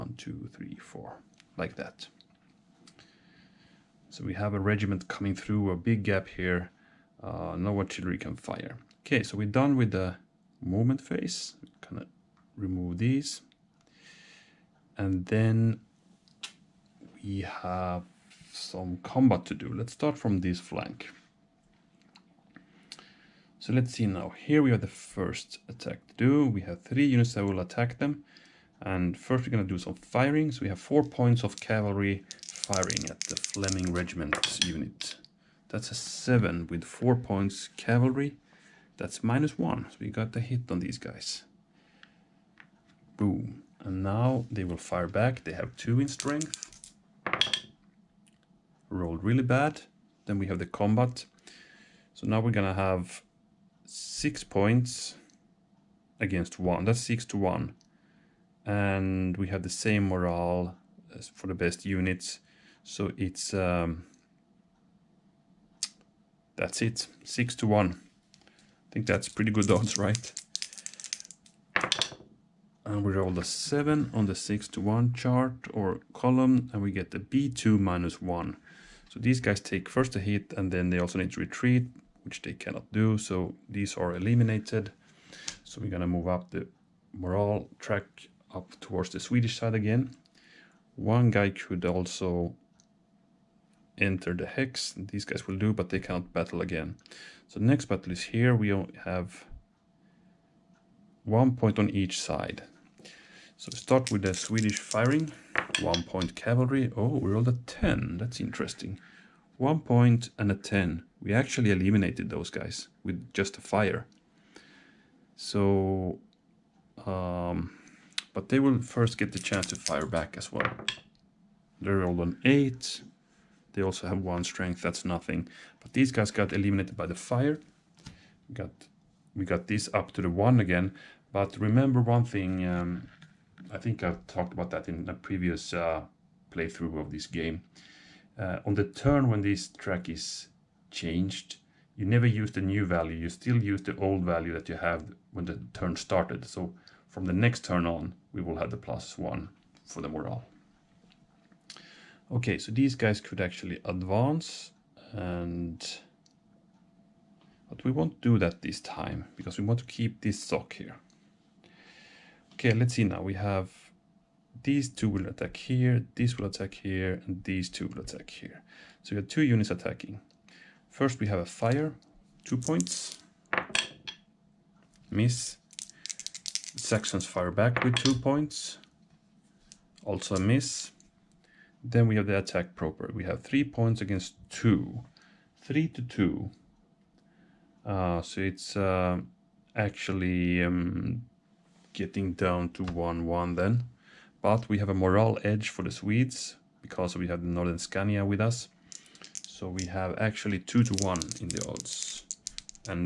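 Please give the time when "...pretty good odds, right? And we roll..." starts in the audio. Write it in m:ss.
1:09.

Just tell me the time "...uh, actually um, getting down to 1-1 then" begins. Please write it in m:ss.
3:08.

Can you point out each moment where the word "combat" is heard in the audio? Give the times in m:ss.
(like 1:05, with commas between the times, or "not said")
0:18, 0:50.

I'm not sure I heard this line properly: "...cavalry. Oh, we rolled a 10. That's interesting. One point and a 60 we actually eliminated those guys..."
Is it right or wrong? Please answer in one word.
wrong.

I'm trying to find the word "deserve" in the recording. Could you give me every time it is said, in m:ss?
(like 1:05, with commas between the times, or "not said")
not said.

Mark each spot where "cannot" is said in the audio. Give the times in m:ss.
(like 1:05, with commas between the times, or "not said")
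1:22, 1:35.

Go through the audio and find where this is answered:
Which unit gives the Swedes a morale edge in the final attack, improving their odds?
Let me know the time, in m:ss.
3:17.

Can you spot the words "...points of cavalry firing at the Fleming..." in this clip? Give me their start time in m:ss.
0:31.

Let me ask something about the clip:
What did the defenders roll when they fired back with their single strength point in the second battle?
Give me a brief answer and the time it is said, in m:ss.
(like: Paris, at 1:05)
8, at 2:02.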